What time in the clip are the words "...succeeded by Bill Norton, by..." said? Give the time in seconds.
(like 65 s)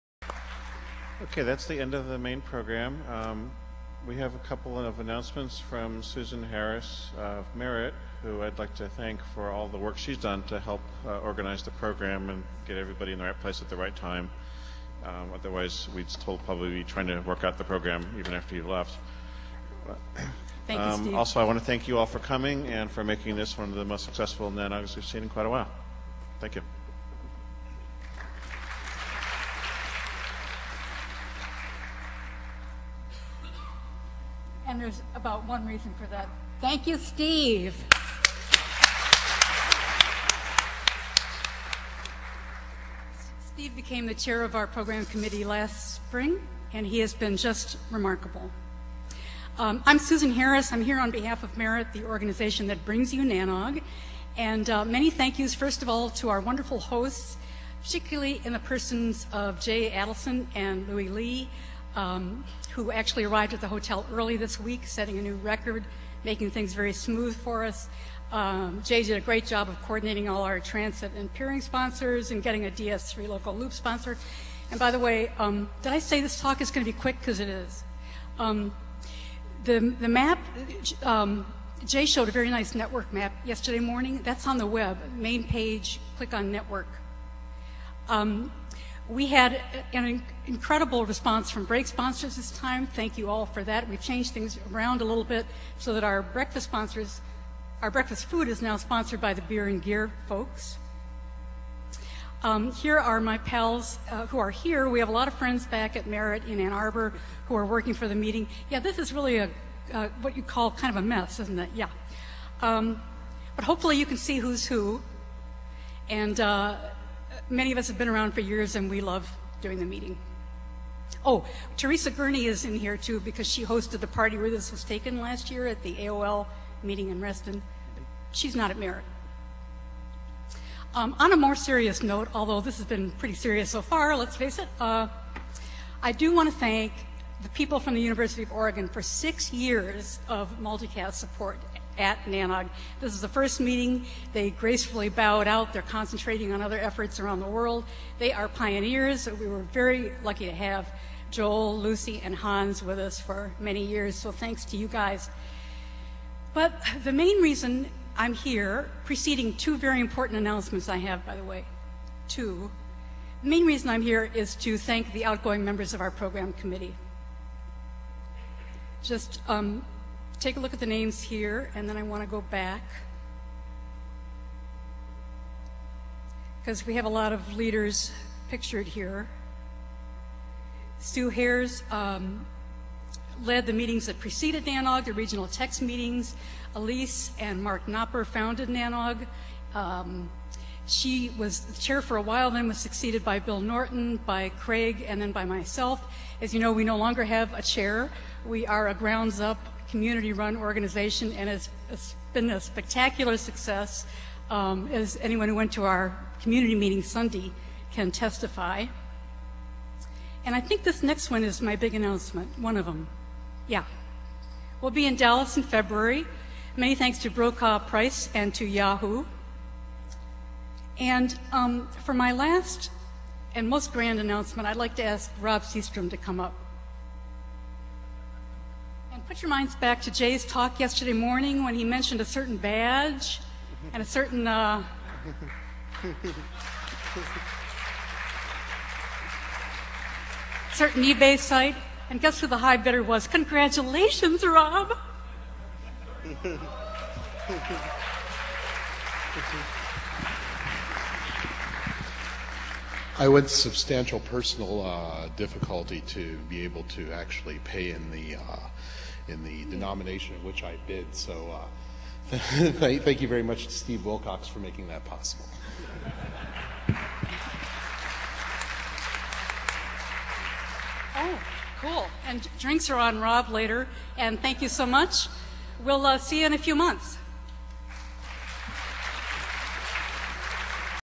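192 s.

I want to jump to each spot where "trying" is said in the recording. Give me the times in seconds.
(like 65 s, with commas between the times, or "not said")
16 s.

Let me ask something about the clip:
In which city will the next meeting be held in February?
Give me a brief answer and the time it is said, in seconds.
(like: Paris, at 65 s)
Dallas, at 215 s.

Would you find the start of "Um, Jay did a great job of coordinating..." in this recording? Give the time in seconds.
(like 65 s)
68 s.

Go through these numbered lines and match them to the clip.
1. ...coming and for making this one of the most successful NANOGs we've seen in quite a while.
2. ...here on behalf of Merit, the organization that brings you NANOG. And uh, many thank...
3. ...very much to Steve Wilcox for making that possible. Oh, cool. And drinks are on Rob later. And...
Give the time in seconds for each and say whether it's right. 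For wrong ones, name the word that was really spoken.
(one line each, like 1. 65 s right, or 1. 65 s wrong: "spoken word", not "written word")
1. 22 s right
2. 50 s right
3. 263 s right.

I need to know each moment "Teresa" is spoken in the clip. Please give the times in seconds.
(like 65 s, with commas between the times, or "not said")
121 s.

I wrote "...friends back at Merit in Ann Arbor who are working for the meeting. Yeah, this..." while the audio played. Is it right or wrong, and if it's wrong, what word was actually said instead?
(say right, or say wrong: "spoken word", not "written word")
right.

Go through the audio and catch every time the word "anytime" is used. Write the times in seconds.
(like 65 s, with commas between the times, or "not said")
not said.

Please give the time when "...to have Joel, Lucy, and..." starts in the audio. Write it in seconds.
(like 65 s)
150 s.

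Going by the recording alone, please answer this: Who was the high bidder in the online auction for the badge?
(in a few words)
Rob Seastrom.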